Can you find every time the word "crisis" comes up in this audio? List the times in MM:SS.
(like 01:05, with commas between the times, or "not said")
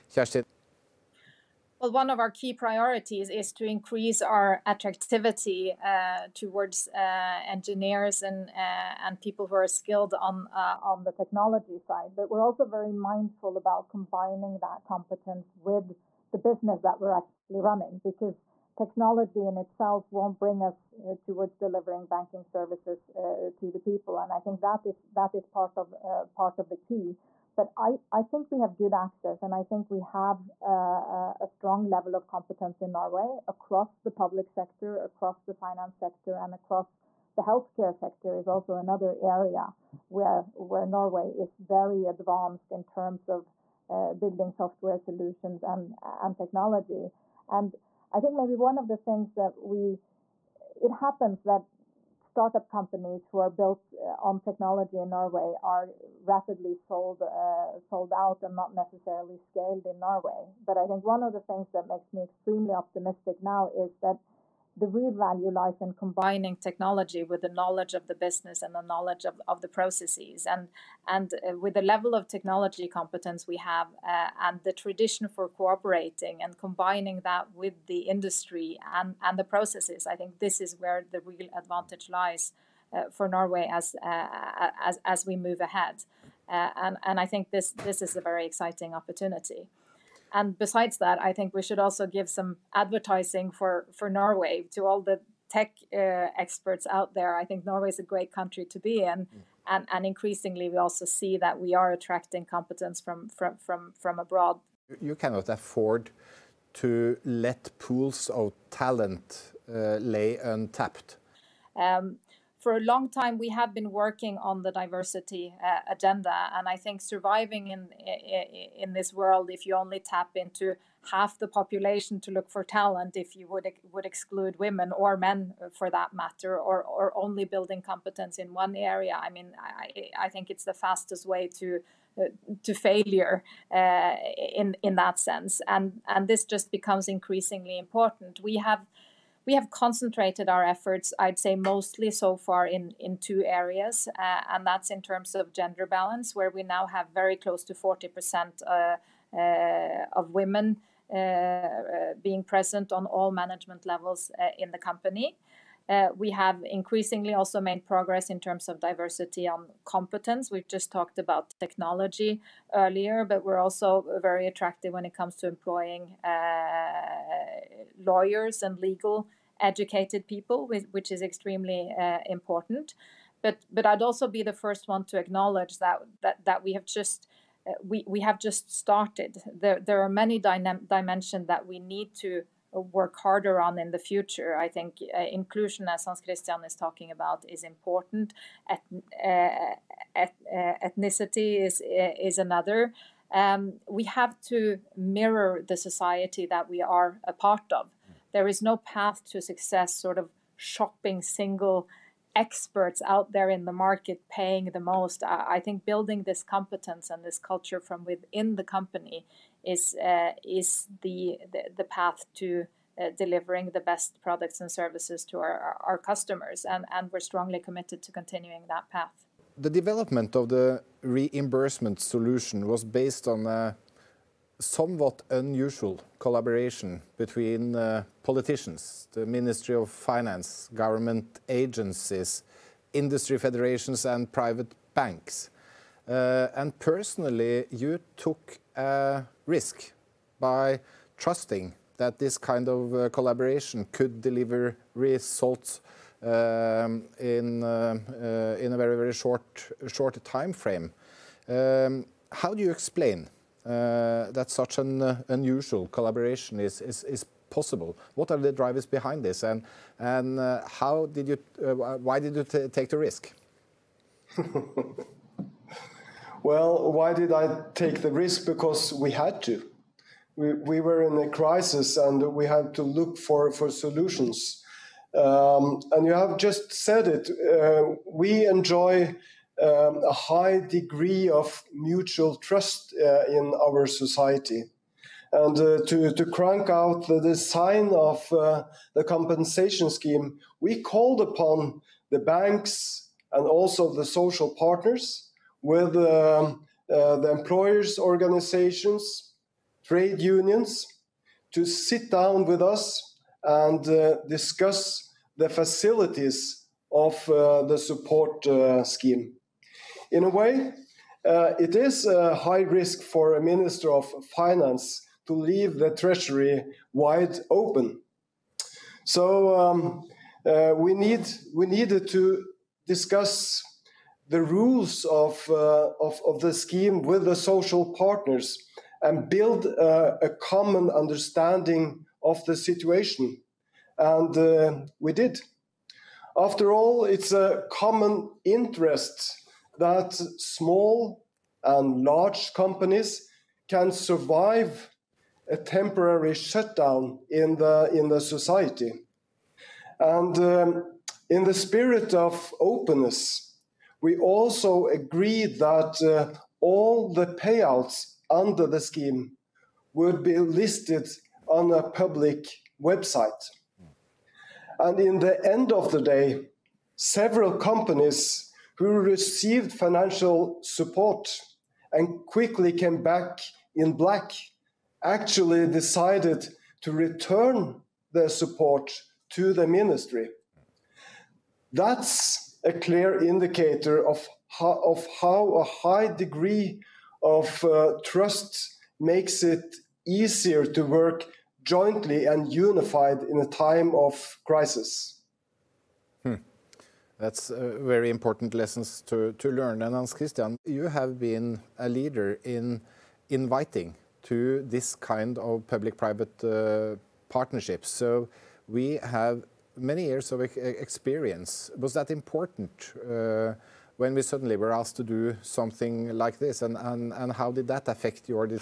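04:31, 06:34.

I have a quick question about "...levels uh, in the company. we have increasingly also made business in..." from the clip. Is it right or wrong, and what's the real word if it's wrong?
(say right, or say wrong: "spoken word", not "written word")
wrong: "progress", not "business".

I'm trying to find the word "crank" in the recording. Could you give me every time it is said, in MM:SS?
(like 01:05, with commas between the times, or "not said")
04:46.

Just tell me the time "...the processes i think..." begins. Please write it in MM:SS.
01:19.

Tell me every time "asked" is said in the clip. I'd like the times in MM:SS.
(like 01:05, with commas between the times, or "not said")
06:54.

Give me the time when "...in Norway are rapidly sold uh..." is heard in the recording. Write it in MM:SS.
00:54.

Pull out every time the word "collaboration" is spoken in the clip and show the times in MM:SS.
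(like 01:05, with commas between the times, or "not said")
03:46, 04:03, 04:15.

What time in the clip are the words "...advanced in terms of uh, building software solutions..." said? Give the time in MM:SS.
00:42.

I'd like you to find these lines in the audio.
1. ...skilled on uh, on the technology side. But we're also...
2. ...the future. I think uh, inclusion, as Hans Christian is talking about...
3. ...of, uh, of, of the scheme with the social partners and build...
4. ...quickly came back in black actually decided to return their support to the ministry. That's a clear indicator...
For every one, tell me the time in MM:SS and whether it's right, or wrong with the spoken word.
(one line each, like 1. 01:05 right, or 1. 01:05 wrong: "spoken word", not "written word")
1. 00:09 right
2. 03:03 right
3. 05:25 right
4. 06:12 right.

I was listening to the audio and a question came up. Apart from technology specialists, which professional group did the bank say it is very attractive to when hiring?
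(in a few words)
Lawyers.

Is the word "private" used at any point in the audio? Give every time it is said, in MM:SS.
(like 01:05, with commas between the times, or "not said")
03:54, 06:45.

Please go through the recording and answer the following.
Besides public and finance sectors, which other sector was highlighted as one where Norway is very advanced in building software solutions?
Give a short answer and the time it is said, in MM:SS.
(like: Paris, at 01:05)
Healthcare, at 00:37.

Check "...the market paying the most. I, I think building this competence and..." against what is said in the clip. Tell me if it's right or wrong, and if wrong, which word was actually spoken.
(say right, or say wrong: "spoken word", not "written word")
right.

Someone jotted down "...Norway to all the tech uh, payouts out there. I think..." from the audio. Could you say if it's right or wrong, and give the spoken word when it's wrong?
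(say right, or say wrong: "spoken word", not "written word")
wrong: "experts", not "payouts".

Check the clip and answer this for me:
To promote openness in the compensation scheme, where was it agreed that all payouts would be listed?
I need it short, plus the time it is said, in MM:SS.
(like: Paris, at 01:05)
A public website, at 06:01.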